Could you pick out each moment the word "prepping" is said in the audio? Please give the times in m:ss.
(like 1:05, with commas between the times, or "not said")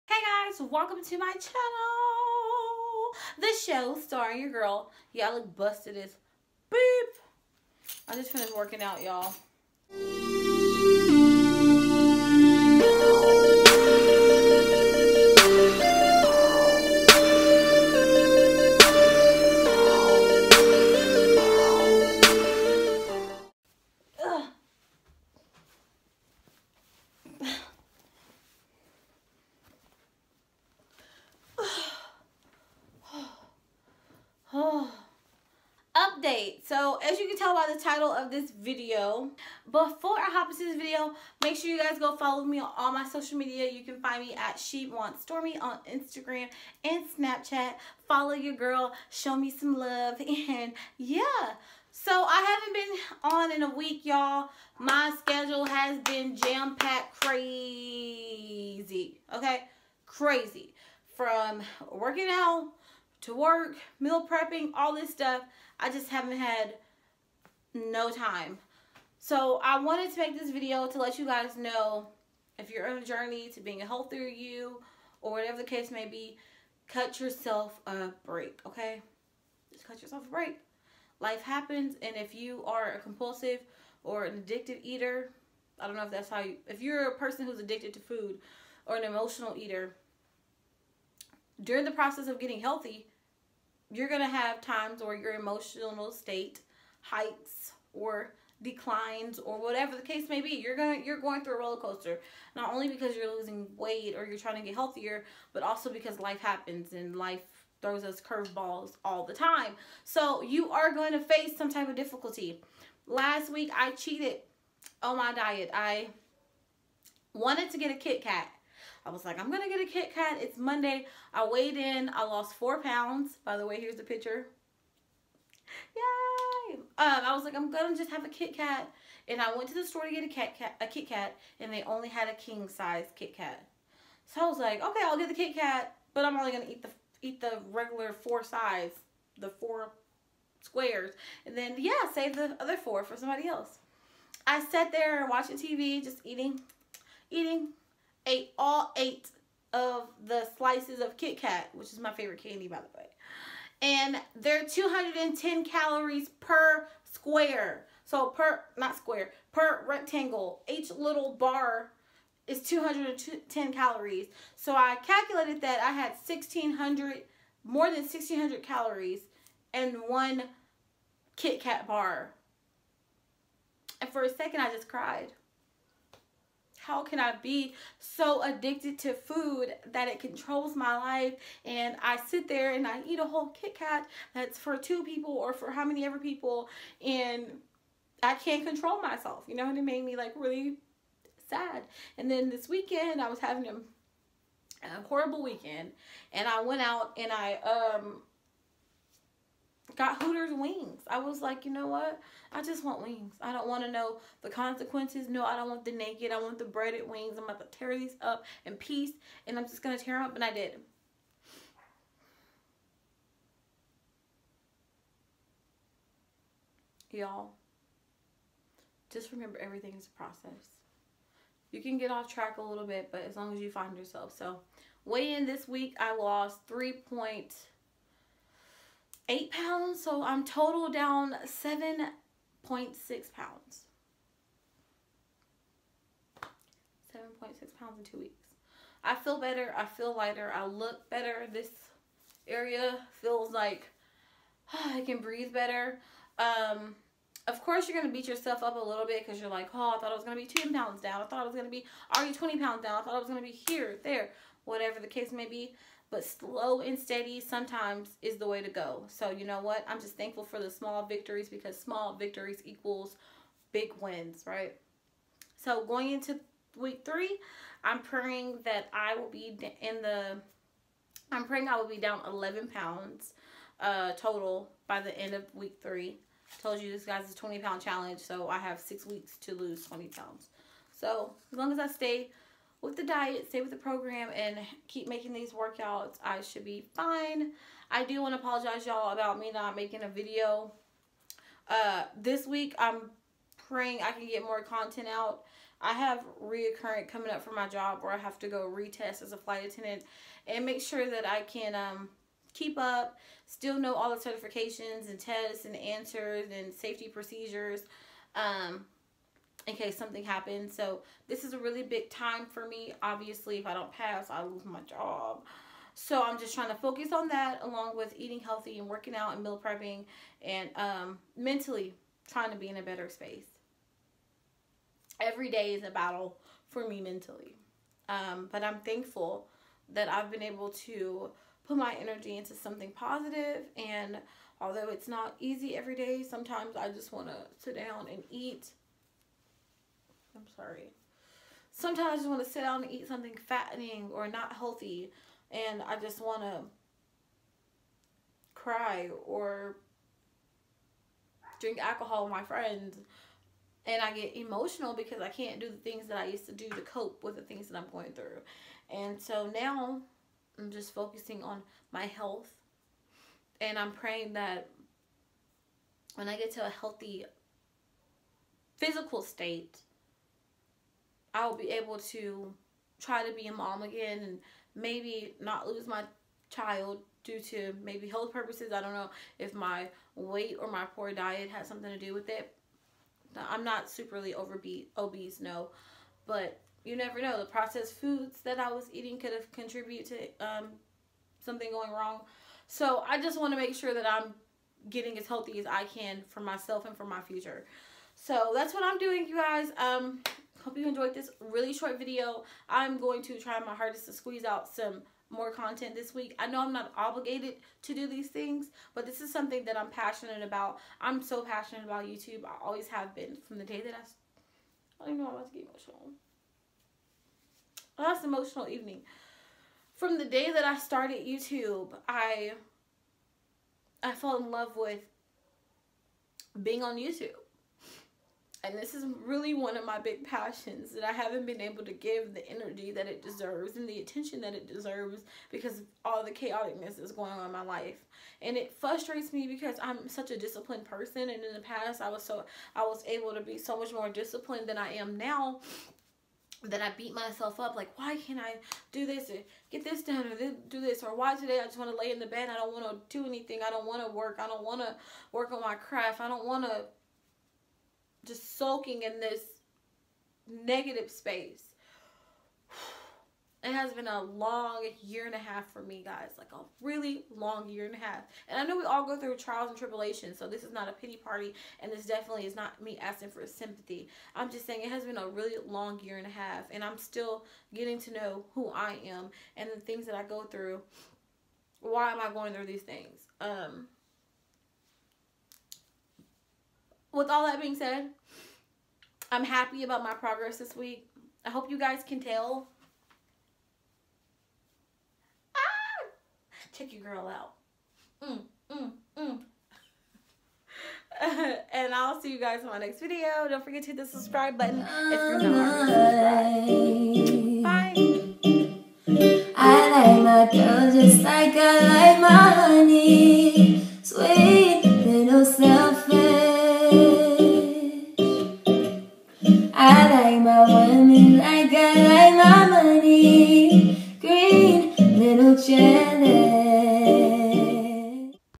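1:04, 5:19.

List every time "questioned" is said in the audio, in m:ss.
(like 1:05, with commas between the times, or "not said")
not said.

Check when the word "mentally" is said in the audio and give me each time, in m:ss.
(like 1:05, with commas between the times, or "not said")
5:21, 5:27.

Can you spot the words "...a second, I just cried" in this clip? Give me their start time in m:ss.
2:54.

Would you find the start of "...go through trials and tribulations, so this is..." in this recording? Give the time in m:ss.
7:49.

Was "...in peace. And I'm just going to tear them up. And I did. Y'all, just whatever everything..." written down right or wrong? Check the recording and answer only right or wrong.
wrong.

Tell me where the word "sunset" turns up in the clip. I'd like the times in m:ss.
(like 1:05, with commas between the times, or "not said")
not said.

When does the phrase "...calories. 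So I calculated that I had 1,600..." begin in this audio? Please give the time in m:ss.
2:43.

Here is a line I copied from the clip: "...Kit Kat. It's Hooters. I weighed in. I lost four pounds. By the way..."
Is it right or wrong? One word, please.
wrong.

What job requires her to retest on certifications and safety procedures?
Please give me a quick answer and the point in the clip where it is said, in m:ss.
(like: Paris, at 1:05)
flight attendant, at 4:59.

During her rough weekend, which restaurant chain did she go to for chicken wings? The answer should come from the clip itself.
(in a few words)
Hooters.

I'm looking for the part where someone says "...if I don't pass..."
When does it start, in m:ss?
5:13.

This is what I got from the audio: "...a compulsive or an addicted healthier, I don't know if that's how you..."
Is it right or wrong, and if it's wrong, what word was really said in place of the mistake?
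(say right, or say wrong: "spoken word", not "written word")
wrong: "eater", not "healthier".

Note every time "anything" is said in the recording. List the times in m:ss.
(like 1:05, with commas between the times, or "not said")
7:33.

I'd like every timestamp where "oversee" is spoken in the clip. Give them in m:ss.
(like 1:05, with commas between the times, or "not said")
not said.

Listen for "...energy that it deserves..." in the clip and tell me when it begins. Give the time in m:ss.
7:12.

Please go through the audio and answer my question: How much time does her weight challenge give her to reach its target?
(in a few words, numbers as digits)
6 weeks.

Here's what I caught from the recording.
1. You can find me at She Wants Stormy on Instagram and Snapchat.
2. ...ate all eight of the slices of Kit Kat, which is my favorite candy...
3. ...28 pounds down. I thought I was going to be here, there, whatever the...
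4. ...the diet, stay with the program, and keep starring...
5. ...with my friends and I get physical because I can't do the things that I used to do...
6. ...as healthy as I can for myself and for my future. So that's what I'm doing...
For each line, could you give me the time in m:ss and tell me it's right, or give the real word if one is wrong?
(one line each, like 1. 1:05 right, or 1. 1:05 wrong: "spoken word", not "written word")
1. 0:43 right
2. 2:28 right
3. 4:12 wrong: "20", not "28"
4. 4:42 wrong: "making", not "starring"
5. 5:52 wrong: "emotional", not "physical"
6. 6:35 right.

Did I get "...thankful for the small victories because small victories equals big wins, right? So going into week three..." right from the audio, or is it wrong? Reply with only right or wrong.
right.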